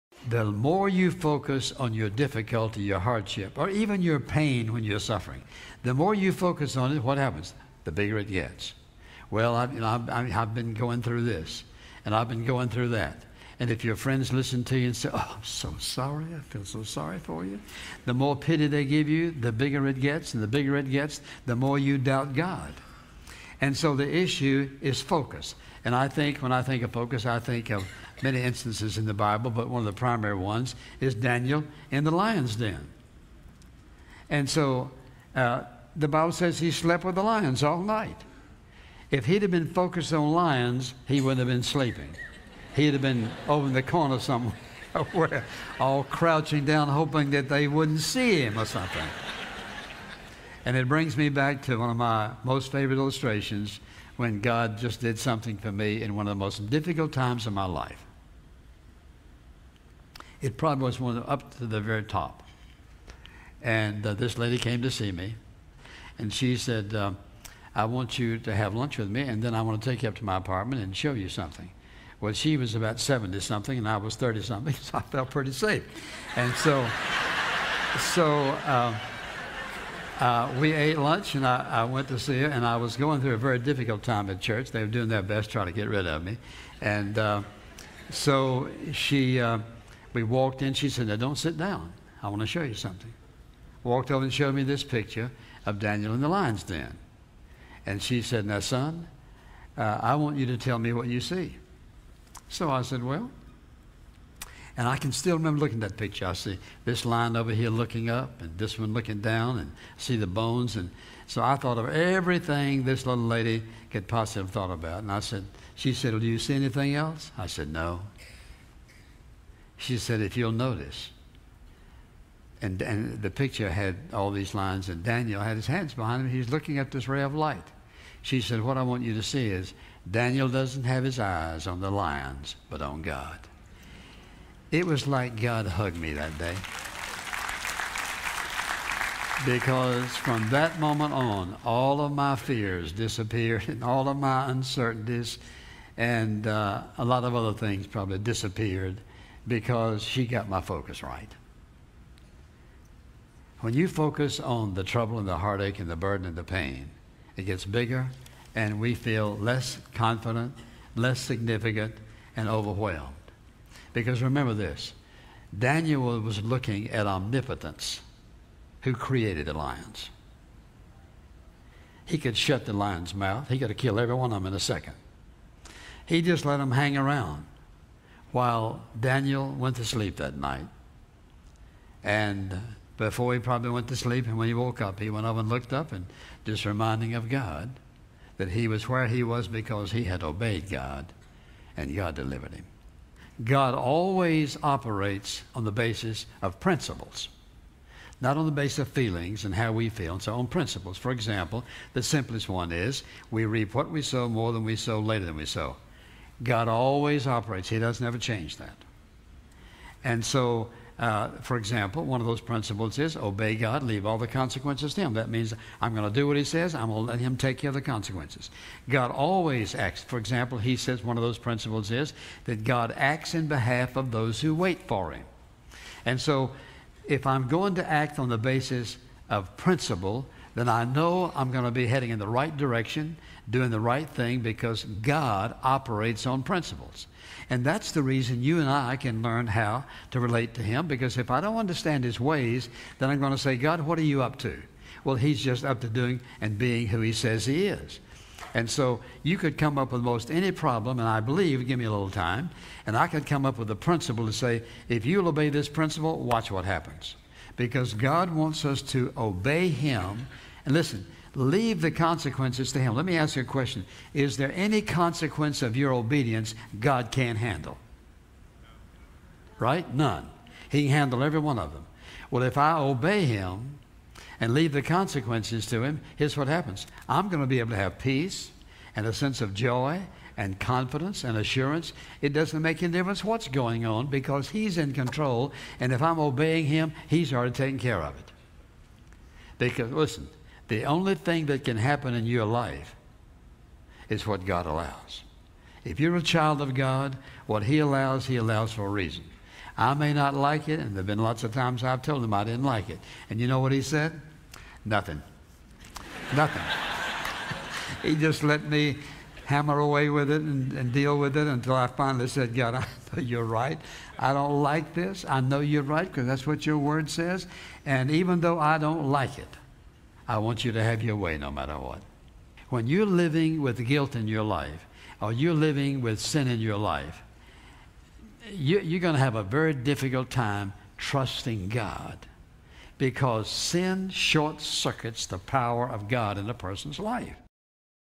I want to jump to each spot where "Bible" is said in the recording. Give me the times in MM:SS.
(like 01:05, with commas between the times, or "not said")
00:29, 00:36.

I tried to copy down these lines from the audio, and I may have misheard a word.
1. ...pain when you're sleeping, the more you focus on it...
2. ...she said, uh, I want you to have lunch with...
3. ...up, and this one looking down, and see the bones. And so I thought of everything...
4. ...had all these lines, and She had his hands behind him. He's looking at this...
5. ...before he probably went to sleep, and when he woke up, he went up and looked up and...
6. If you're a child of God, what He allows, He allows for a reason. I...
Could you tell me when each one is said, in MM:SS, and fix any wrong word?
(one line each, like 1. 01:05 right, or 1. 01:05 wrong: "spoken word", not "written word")
1. 00:04 wrong: "suffering", not "sleeping"
2. 01:06 right
3. 01:48 right
4. 02:03 wrong: "Daniel", not "She"
5. 03:02 right
6. 04:55 right.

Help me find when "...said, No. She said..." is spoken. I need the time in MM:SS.
01:57.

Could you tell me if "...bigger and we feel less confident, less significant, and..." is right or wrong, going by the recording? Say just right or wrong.
right.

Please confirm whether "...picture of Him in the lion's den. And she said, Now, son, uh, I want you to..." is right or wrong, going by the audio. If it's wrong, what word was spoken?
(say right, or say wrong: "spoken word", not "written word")
wrong: "Daniel", not "Him".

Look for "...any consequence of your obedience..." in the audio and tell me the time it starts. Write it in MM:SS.
04:24.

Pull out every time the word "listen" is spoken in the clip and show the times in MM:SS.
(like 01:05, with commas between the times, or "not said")
00:14, 04:20, 04:49.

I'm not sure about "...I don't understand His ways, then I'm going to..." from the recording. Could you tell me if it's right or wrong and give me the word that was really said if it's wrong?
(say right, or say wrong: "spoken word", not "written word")
right.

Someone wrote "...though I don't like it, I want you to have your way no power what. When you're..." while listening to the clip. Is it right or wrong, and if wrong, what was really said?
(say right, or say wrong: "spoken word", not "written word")
wrong: "matter", not "power".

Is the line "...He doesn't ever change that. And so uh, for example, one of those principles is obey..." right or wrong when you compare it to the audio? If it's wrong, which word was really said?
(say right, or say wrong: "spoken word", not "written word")
right.